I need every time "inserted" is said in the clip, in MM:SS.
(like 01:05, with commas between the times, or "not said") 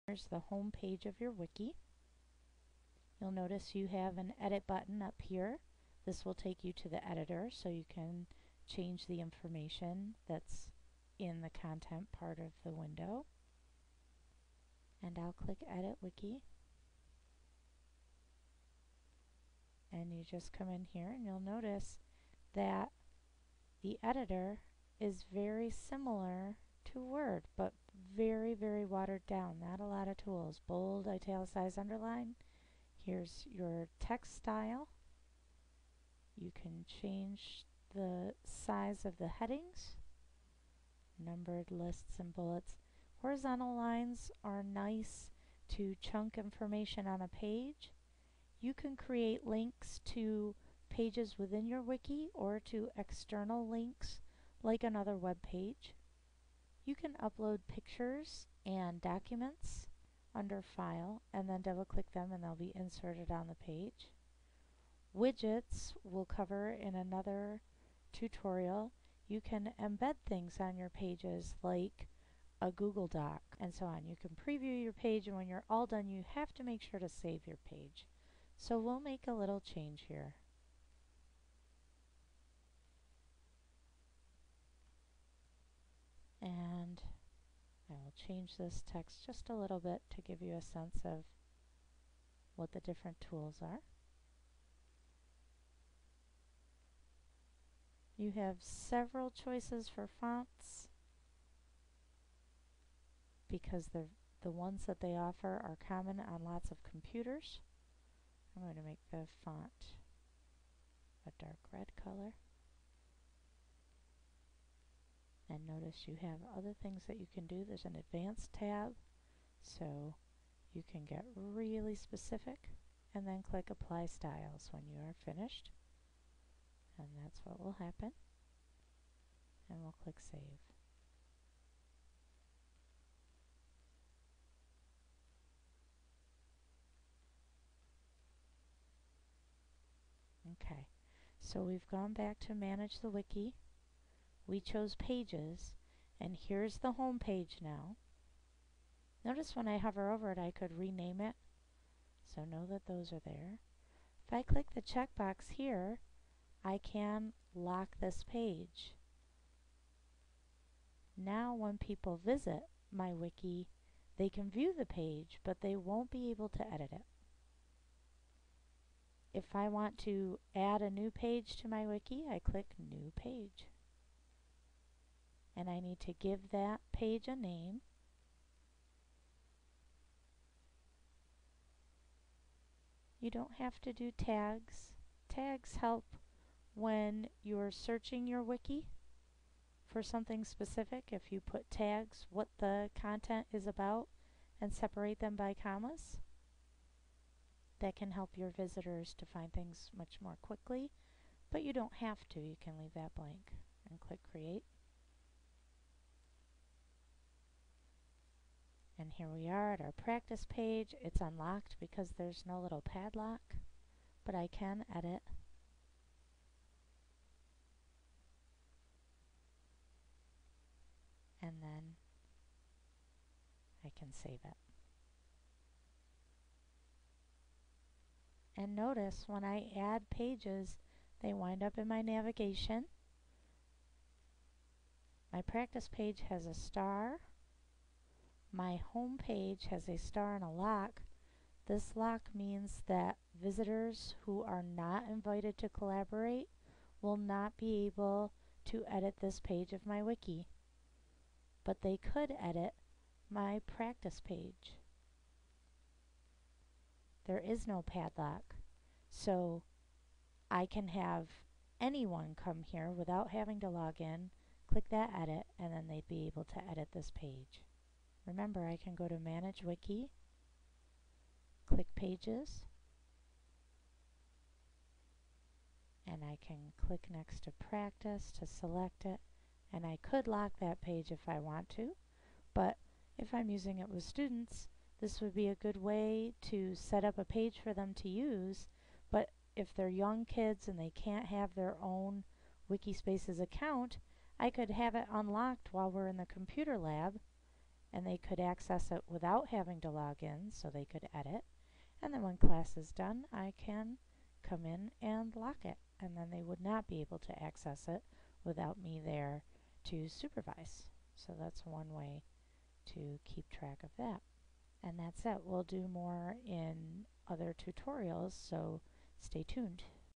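01:02.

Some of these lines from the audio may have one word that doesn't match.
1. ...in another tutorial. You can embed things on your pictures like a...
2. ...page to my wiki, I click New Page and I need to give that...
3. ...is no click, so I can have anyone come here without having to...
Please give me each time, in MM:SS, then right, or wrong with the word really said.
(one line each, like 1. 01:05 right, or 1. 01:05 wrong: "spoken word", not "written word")
1. 01:06 wrong: "pages", not "pictures"
2. 02:51 right
3. 04:17 wrong: "padlock", not "click".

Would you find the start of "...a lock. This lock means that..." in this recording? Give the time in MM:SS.
04:00.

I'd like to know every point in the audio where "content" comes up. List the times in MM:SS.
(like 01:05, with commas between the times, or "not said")
00:11, 03:12.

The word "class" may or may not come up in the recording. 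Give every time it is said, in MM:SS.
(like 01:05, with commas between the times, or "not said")
05:02.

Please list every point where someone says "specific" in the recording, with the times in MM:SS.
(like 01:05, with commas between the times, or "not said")
02:01, 03:10.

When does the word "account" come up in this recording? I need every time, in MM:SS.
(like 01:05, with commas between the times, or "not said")
04:53.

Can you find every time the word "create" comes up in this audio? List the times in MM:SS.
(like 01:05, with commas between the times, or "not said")
00:48, 03:24.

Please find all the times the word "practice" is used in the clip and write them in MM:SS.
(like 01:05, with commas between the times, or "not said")
03:29, 03:55, 04:13, 04:37.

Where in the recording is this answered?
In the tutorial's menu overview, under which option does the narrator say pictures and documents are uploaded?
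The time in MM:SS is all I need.
01:00.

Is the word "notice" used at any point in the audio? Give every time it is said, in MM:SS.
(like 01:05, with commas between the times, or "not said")
00:03, 00:21, 01:55, 02:29, 03:48.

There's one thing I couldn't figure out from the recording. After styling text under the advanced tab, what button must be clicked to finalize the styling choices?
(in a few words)
apply styles.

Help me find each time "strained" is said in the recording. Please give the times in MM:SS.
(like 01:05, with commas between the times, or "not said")
not said.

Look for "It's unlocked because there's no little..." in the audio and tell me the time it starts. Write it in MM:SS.
03:31.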